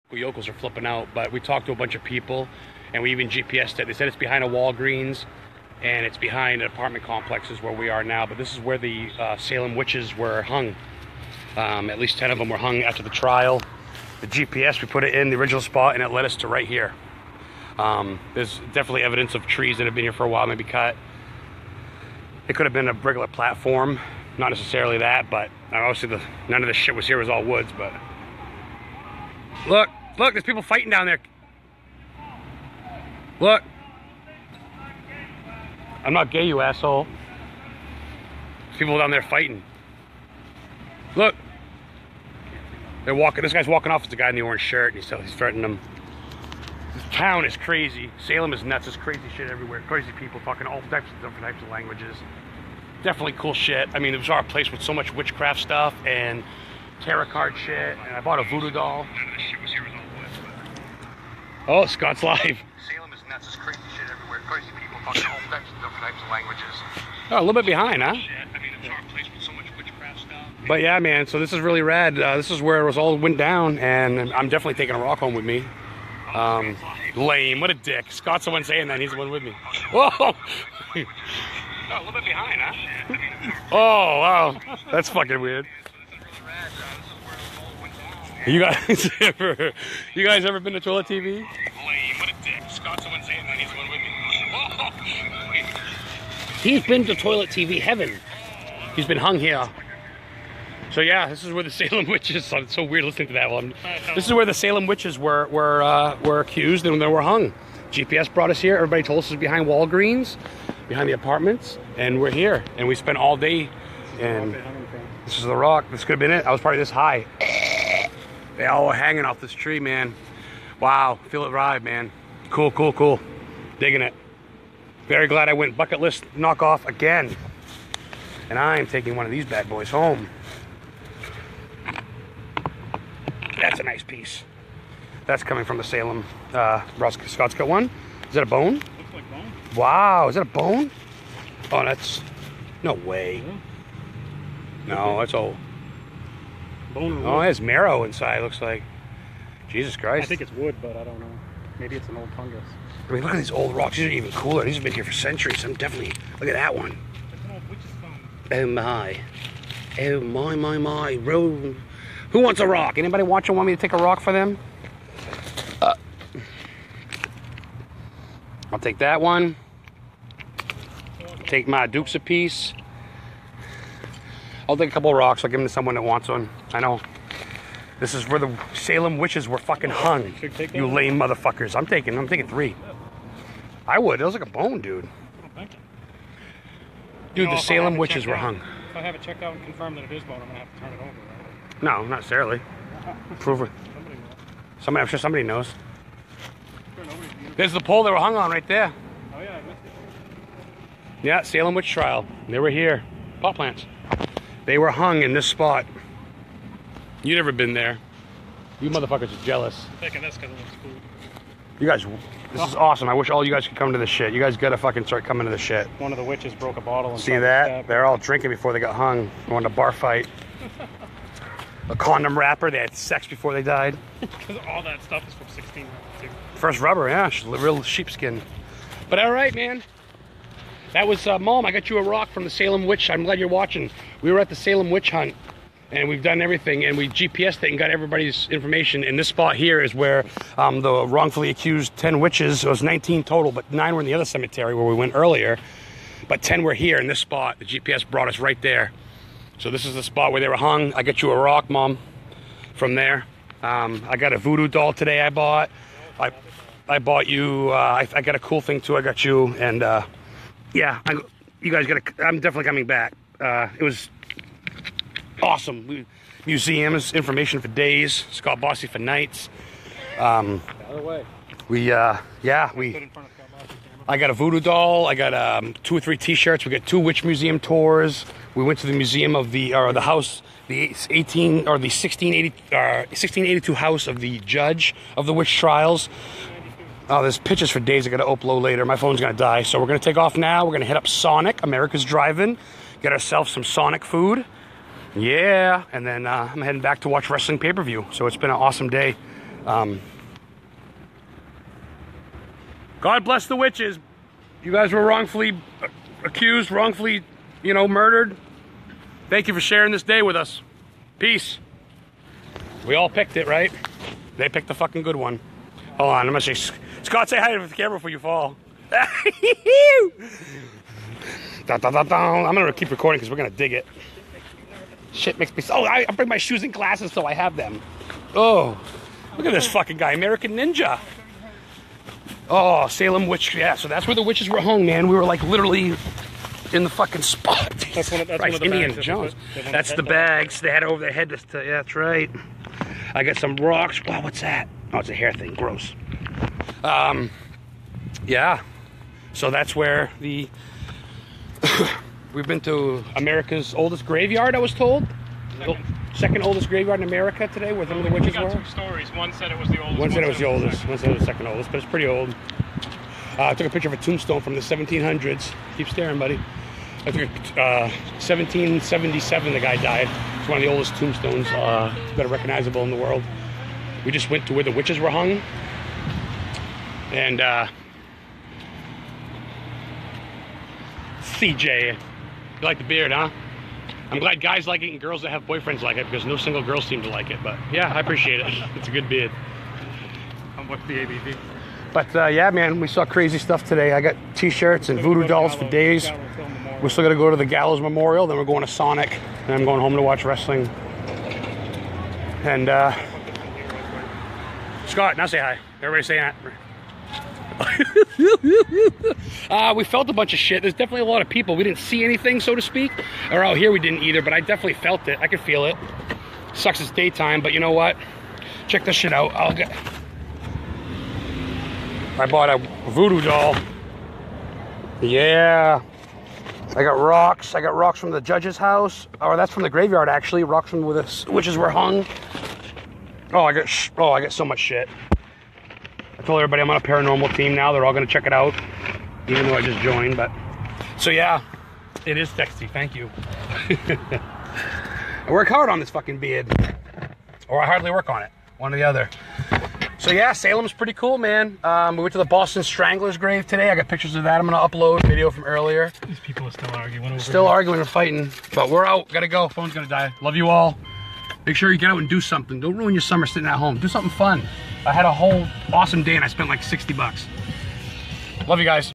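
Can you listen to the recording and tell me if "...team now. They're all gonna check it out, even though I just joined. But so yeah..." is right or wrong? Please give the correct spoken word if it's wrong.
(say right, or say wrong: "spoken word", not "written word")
right.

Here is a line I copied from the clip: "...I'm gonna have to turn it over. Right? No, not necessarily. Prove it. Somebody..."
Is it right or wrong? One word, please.
right.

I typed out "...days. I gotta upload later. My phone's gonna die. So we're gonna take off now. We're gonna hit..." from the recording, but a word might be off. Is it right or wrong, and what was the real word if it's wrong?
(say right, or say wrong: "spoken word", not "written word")
right.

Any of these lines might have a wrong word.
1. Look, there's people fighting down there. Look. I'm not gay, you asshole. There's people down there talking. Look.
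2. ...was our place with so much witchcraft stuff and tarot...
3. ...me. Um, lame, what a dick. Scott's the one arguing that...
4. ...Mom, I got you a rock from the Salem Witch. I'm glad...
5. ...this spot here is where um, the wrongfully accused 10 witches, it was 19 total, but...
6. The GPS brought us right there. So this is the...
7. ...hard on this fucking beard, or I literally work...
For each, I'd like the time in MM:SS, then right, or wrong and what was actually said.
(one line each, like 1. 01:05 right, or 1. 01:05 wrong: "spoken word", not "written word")
1. 00:30 wrong: "fighting", not "talking"
2. 00:54 right
3. 01:15 wrong: "saying", not "arguing"
4. 03:51 right
5. 03:59 right
6. 04:07 right
7. 07:25 wrong: "hardly", not "literally".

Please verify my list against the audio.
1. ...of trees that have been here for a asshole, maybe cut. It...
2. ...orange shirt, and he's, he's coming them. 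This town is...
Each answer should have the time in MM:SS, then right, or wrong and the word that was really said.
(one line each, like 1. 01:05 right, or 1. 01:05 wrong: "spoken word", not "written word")
1. 00:19 wrong: "while", not "asshole"
2. 00:44 wrong: "threatening", not "coming".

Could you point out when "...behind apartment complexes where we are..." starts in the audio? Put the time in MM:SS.
00:06.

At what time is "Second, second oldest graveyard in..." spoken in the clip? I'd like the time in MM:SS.
05:55.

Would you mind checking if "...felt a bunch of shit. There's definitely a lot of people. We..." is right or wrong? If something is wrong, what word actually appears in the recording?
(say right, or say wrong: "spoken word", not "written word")
right.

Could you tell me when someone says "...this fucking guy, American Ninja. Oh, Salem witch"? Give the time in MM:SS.
05:29.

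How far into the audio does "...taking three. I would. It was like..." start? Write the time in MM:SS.
03:02.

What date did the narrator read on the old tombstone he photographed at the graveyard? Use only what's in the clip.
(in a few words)
1777.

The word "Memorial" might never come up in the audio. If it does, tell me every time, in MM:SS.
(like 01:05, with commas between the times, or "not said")
06:37.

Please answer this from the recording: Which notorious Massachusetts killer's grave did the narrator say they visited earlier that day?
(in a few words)
The Boston Strangler.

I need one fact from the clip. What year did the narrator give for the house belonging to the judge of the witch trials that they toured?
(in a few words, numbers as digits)
1682.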